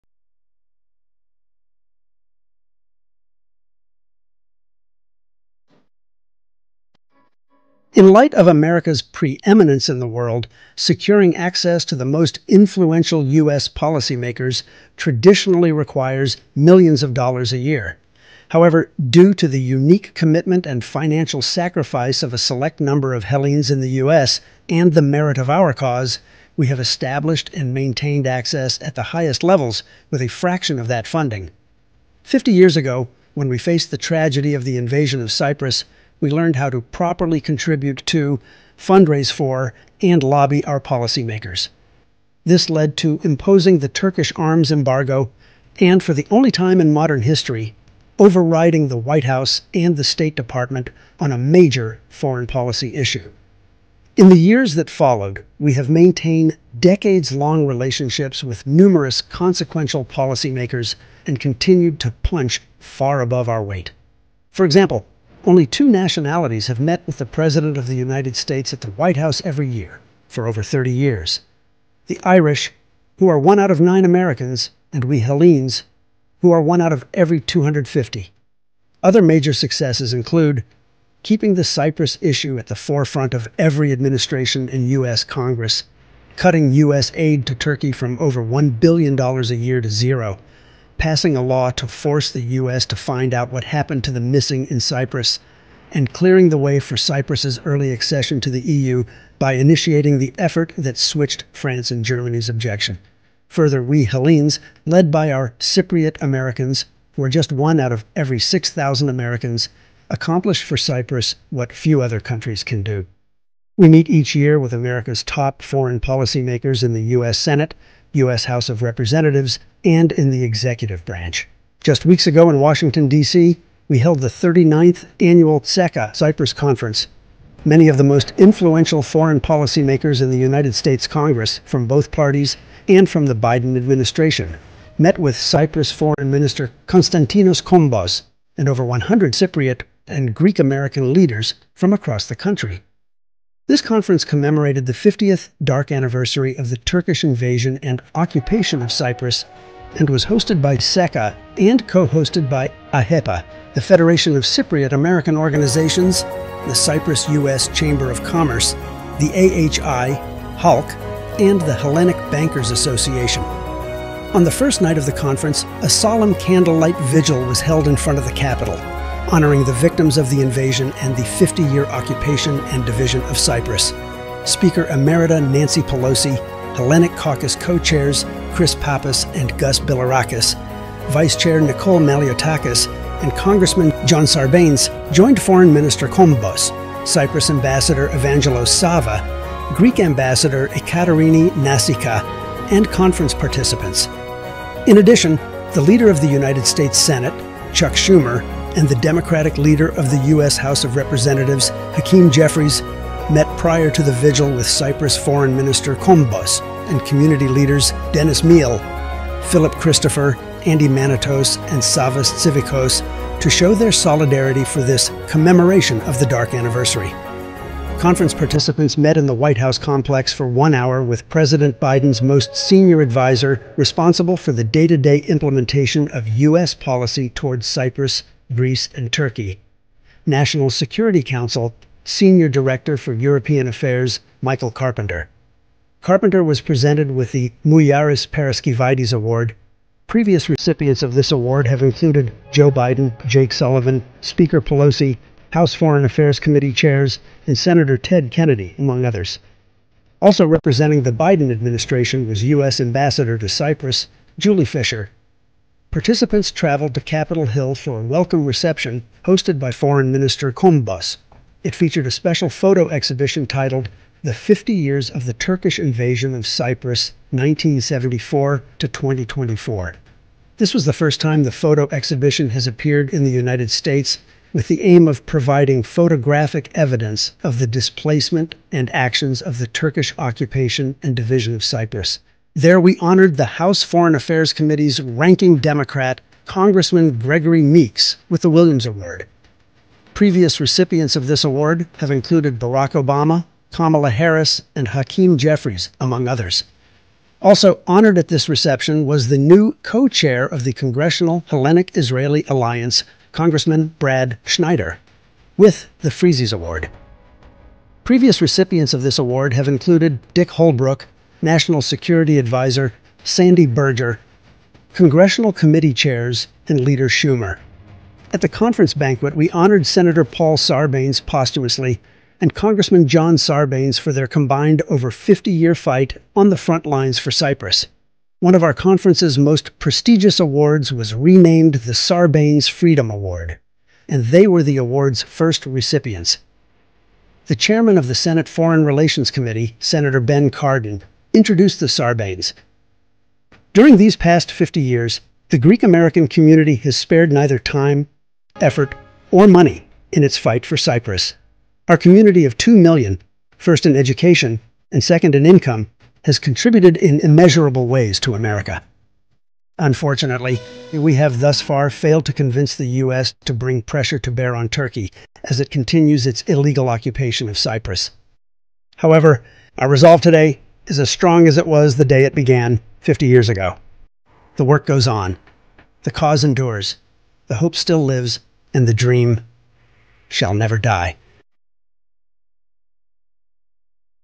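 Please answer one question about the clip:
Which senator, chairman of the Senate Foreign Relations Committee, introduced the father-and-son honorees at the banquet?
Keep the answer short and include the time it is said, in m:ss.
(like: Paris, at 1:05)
Ben Cardin, at 5:40.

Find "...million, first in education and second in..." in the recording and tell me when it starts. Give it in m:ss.
5:52.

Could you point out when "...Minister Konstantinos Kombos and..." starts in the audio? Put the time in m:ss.
2:16.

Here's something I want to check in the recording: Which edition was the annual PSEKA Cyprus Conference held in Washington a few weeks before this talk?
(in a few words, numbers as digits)
39th.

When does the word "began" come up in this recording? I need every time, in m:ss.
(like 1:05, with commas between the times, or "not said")
6:12.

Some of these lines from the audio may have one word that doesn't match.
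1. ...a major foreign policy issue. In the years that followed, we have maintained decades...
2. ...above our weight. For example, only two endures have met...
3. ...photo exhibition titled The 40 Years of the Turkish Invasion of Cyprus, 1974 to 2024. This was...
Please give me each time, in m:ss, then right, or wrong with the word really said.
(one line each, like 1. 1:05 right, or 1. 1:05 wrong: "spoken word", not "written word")
1. 0:51 right
2. 1:03 wrong: "nationalities", not "endures"
3. 4:22 wrong: "50", not "40".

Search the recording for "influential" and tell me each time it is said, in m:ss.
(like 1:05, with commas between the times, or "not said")
0:12, 2:08.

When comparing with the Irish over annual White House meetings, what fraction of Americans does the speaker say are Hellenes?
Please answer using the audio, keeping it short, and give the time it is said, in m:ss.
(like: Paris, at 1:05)
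1 out of 250, at 1:16.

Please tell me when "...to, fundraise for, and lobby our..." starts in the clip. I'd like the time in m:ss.
0:38.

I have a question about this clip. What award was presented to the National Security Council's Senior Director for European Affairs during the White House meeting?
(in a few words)
Mouyiaris Paraskevaides Award.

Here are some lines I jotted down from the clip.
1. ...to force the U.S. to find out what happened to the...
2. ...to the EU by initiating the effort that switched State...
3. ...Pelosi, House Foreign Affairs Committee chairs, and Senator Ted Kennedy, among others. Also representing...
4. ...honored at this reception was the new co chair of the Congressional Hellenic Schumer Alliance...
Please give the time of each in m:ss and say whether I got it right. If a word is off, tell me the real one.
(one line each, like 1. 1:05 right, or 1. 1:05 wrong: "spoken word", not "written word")
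1. 1:31 right
2. 1:38 wrong: "France", not "State"
3. 4:04 right
4. 4:57 wrong: "Israeli", not "Schumer".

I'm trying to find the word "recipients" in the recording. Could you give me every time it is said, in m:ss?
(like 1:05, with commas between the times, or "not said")
4:00, 4:50, 5:08, 5:35.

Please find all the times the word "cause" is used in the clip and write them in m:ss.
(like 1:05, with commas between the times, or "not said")
0:25, 6:16.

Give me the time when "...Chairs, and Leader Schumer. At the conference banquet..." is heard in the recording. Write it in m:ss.
5:15.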